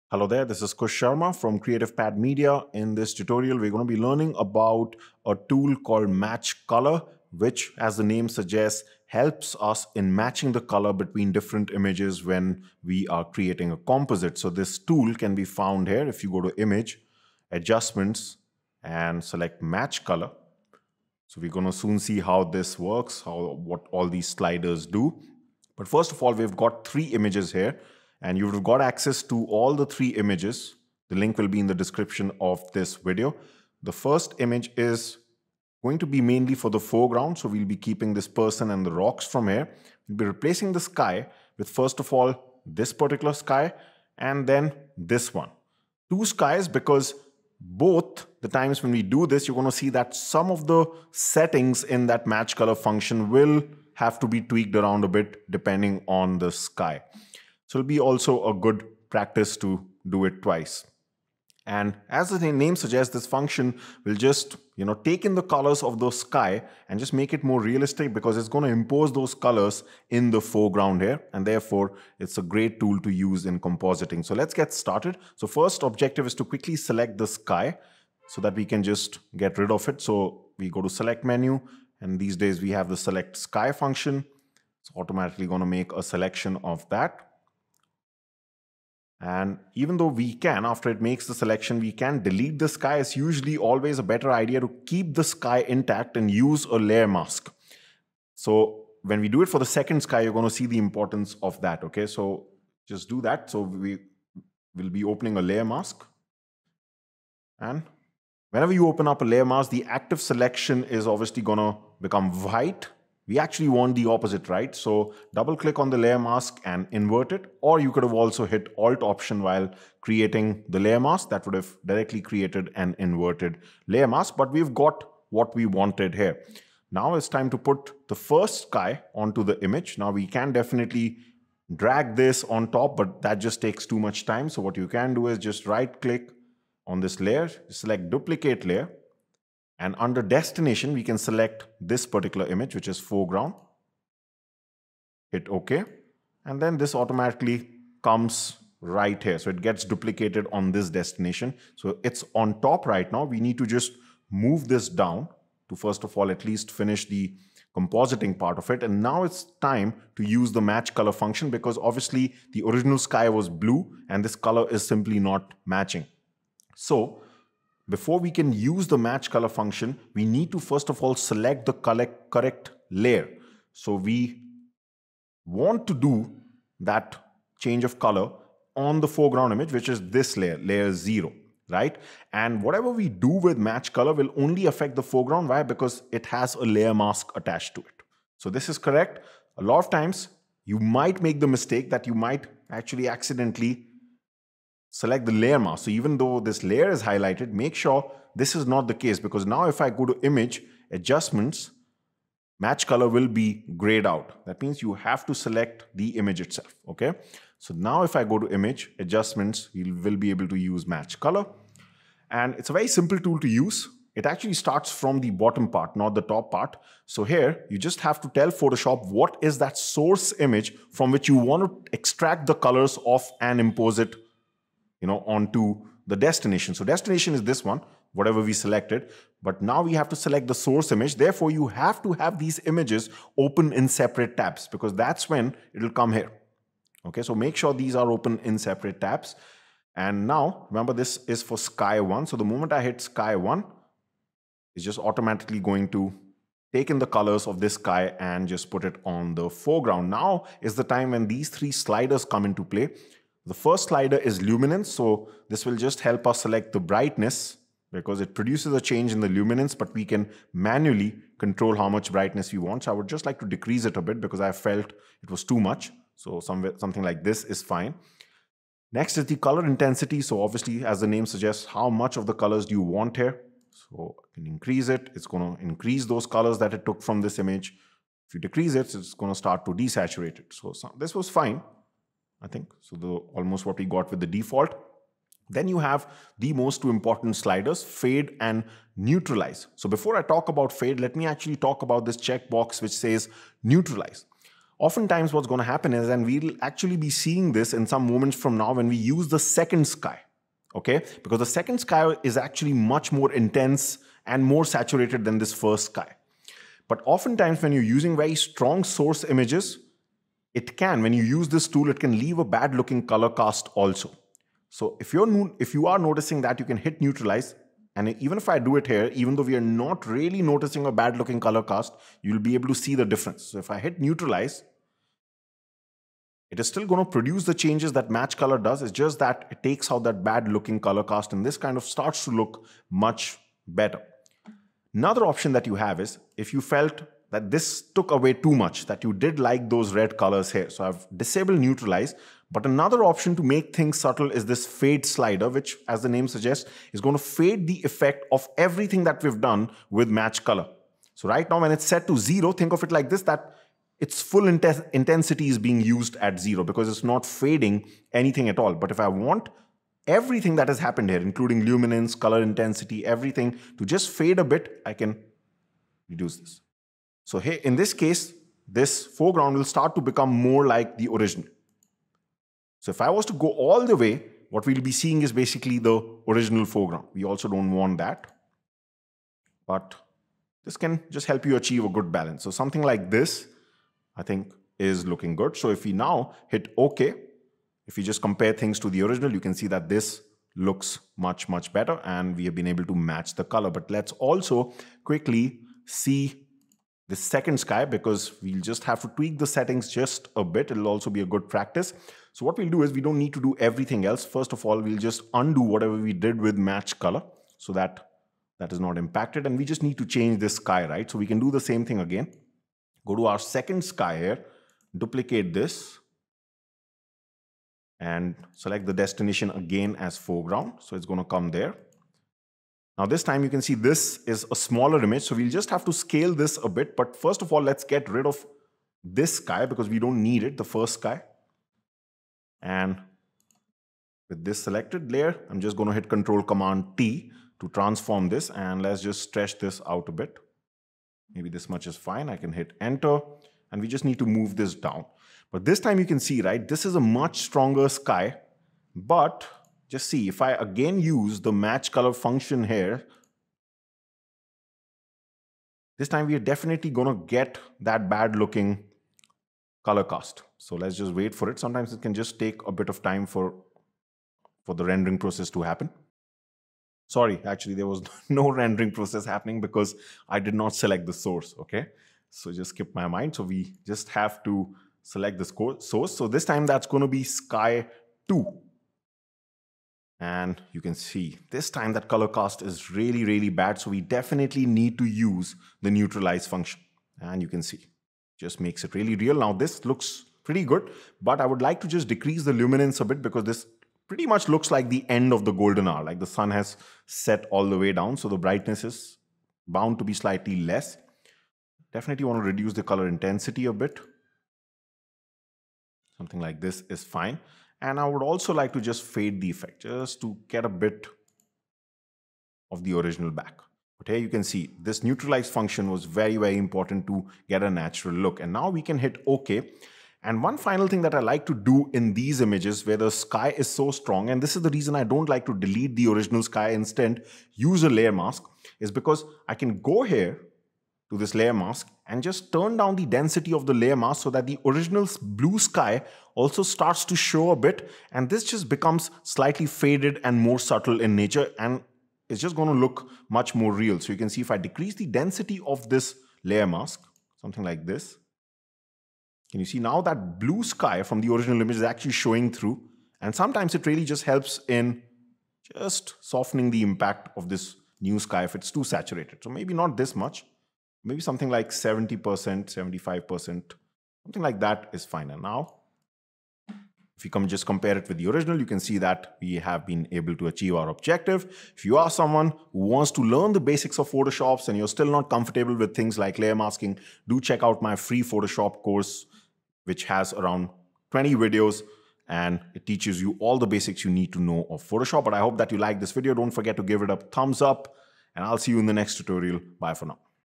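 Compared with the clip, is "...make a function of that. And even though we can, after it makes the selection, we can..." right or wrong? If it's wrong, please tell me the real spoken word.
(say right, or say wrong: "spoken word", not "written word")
wrong: "selection", not "function".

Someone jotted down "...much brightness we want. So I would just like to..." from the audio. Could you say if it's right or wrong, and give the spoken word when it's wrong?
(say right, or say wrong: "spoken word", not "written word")
right.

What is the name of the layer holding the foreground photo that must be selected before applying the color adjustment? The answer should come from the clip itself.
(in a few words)
layer zero.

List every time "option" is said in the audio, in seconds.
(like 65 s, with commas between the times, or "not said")
119 s, 335 s, 343 s.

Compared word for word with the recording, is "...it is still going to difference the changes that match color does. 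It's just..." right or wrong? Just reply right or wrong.
wrong.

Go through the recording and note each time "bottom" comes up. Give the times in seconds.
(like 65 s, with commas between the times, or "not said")
215 s.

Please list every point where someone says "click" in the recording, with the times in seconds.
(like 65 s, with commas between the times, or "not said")
115 s, 136 s.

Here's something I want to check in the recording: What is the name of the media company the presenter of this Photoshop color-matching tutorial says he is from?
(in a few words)
Creative Pad Media.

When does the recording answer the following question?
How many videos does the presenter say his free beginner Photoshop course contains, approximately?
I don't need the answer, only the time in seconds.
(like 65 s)
581 s.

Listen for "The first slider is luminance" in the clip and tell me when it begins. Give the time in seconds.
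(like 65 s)
253 s.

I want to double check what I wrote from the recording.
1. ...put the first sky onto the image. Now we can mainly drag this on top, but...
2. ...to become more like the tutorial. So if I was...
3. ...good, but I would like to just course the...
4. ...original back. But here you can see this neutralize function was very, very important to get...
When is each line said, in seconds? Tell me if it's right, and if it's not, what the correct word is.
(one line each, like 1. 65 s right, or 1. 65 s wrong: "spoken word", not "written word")
1. 127 s wrong: "definitely", not "mainly"
2. 369 s wrong: "original", not "tutorial"
3. 490 s wrong: "decrease", not "course"
4. 512 s right.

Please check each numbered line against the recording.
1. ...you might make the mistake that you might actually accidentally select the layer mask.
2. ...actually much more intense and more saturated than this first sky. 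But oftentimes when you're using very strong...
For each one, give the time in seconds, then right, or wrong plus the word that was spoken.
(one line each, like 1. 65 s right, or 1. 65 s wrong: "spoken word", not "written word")
1. 190 s right
2. 302 s right.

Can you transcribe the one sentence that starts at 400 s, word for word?
It'll also be a good practice.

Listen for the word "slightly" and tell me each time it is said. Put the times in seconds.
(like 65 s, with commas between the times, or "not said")
500 s, 539 s.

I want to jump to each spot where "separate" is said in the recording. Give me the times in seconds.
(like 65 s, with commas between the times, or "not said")
233 s, 238 s.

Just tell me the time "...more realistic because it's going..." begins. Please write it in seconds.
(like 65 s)
67 s.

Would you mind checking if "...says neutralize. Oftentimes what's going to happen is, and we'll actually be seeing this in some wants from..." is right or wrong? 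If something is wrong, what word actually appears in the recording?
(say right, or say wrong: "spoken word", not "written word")
wrong: "moments", not "wants".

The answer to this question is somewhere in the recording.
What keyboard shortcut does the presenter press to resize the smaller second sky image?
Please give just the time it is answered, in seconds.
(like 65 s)
436 s.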